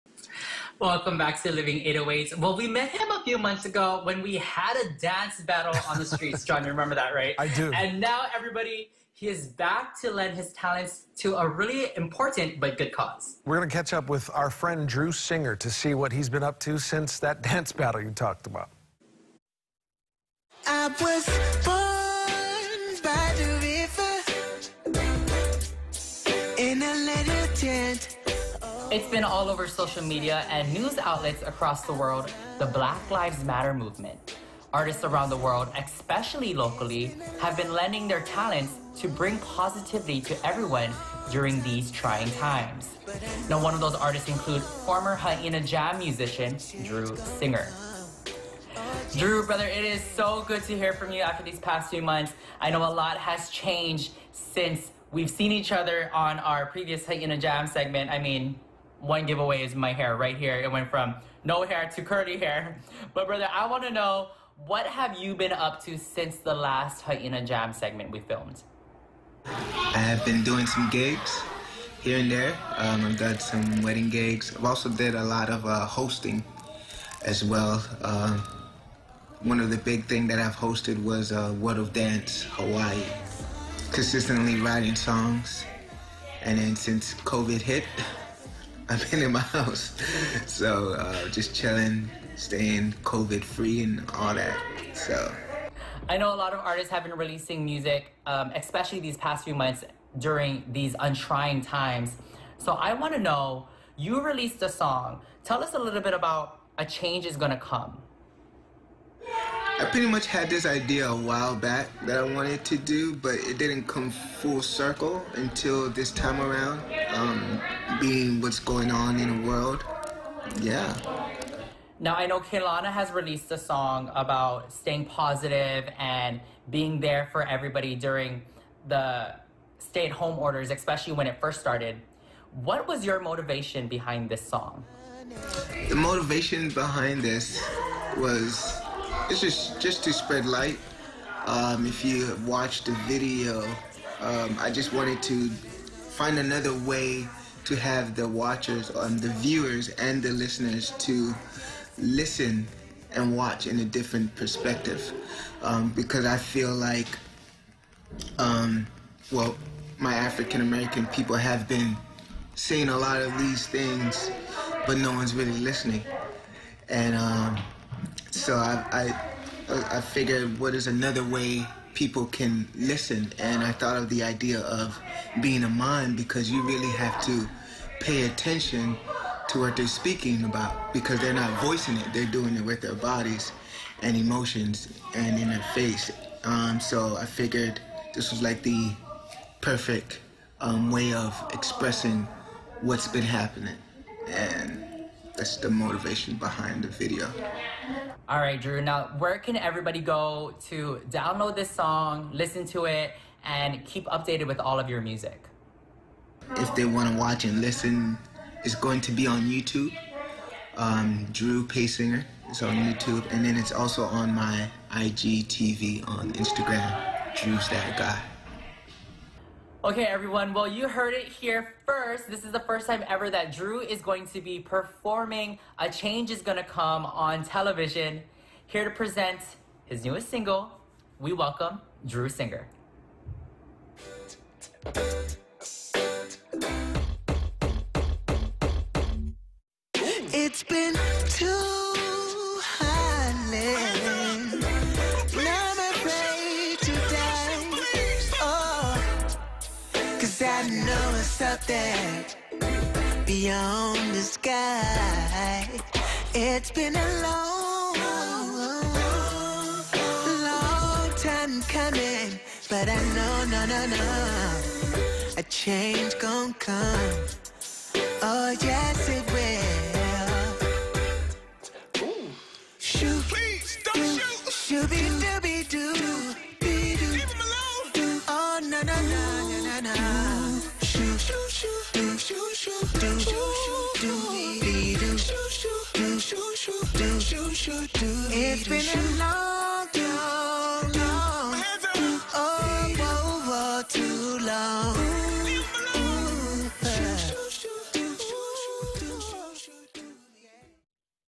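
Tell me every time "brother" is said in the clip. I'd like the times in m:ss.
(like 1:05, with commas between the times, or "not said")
0:49, 1:03.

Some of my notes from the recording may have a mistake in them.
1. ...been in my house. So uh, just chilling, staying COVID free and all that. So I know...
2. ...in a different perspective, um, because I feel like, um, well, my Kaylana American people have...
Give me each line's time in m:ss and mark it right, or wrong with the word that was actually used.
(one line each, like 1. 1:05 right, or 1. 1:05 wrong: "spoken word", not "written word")
1. 1:29 right
2. 2:33 wrong: "African", not "Kaylana".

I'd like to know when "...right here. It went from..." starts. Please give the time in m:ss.
1:00.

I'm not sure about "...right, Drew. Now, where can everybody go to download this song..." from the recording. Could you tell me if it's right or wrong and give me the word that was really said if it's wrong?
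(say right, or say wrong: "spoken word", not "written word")
right.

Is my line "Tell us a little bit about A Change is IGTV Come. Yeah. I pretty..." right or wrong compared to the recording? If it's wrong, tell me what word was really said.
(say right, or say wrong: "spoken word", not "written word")
wrong: "Gonna", not "IGTV".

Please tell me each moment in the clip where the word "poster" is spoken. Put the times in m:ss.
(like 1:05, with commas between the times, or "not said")
not said.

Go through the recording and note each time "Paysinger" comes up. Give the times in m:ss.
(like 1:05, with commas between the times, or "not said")
3:31.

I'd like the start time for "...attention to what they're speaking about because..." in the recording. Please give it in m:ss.
2:58.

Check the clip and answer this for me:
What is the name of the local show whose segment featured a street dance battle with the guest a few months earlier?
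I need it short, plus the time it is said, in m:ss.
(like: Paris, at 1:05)
Living 808s, at 0:01.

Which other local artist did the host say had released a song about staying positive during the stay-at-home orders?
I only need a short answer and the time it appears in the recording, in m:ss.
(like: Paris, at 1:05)
Kaylana, at 2:02.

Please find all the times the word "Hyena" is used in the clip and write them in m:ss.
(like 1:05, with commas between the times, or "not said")
0:45, 0:57, 1:07.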